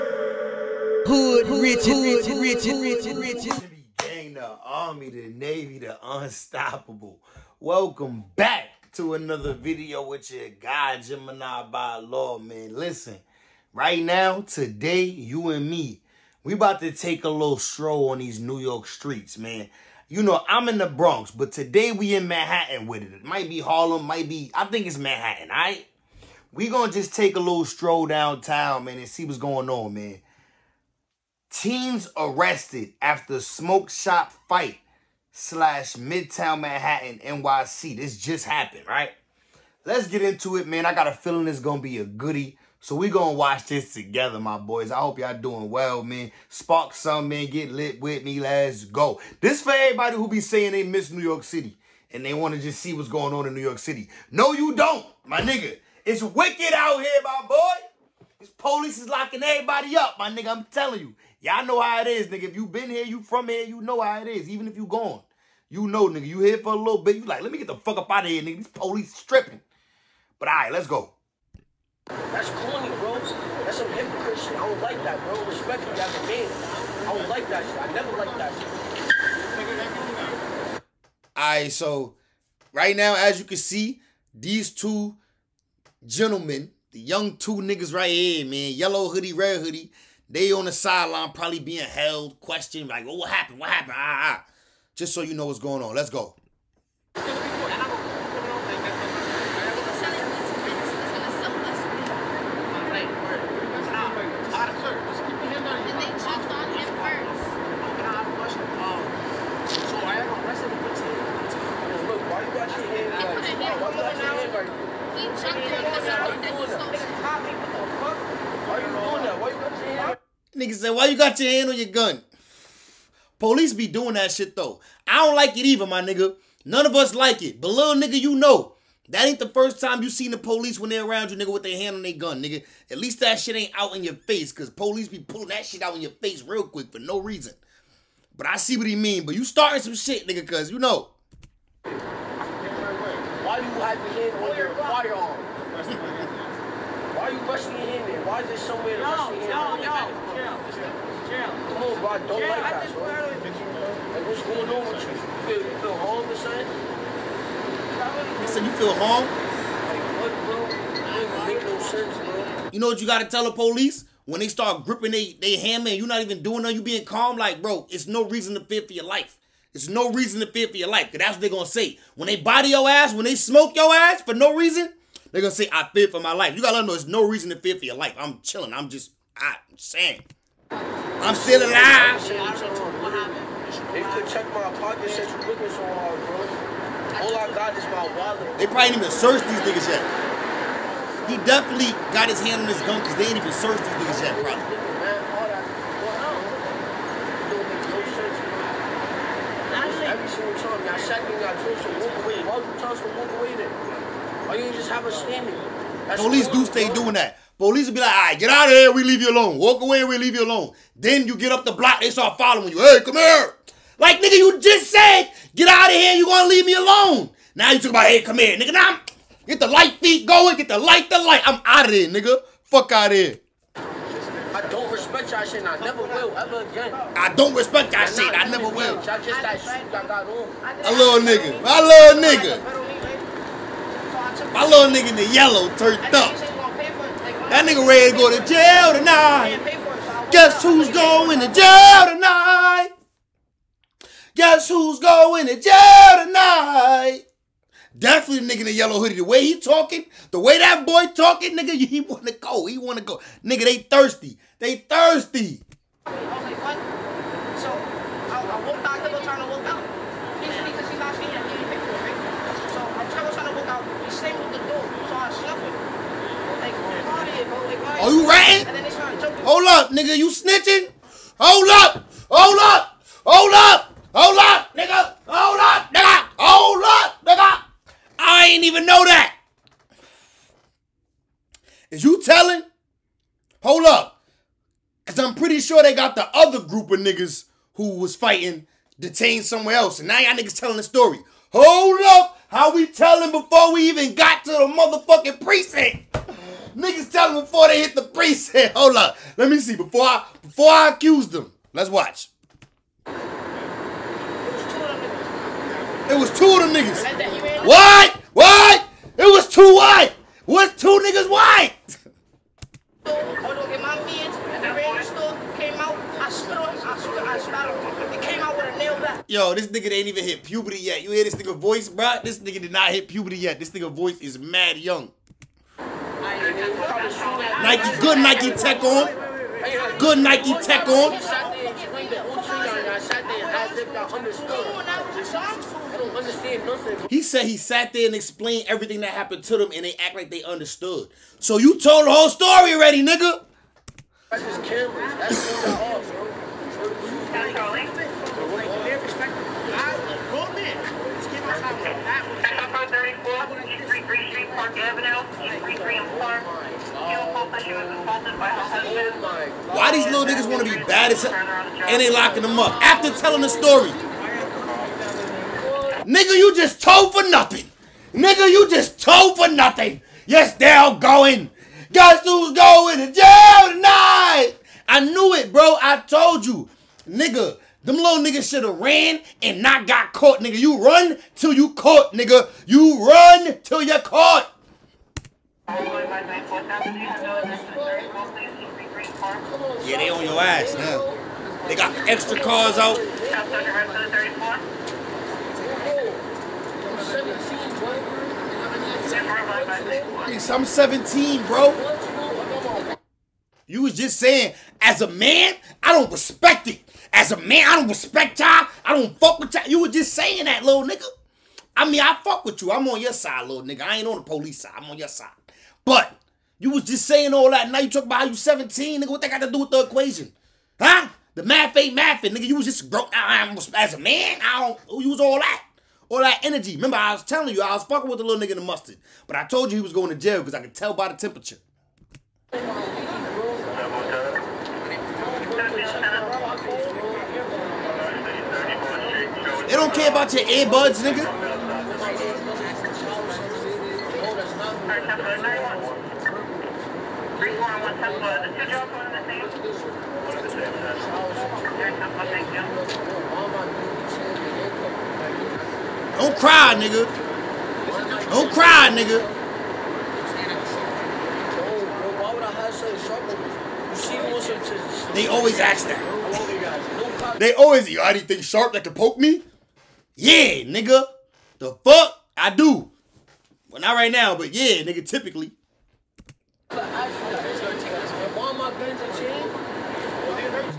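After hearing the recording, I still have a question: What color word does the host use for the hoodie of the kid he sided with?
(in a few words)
Mustard.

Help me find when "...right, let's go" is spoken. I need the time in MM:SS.
01:10.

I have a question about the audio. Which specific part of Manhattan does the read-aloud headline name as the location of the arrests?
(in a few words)
Midtown.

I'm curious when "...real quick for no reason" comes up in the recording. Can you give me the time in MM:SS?
02:16.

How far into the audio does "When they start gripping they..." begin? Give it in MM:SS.
02:44.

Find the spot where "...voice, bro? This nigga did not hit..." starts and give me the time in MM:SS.
05:21.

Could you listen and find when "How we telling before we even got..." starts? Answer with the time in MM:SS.
04:52.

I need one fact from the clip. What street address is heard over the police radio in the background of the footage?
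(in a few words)
333 Park Avenue.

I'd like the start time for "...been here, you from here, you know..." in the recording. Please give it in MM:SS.
01:02.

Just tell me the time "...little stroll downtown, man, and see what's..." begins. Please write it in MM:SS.
00:27.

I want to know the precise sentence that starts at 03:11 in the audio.
He definitely got his hand on his gun because they ain't even searched these niggas yet, probably.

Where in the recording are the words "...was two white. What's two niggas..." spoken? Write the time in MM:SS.
05:09.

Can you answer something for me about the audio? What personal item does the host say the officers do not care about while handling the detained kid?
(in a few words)
Earbuds.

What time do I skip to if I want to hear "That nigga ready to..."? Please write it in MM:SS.
03:57.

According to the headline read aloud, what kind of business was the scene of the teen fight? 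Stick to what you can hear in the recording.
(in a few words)
Smoke shop.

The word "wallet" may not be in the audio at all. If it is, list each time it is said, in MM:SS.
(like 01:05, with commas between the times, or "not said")
03:08.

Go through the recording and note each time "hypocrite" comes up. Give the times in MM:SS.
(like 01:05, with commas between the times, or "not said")
01:13.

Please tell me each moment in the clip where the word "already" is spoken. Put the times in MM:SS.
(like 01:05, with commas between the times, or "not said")
05:42, 07:47.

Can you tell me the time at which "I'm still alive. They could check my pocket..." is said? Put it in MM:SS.
03:01.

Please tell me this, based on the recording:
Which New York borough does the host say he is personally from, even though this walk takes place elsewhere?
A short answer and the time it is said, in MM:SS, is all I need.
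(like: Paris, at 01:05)
The Bronx, at 00:20.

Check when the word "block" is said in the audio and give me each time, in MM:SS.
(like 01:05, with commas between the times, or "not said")
03:31.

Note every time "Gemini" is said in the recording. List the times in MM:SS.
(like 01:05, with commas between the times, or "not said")
00:10.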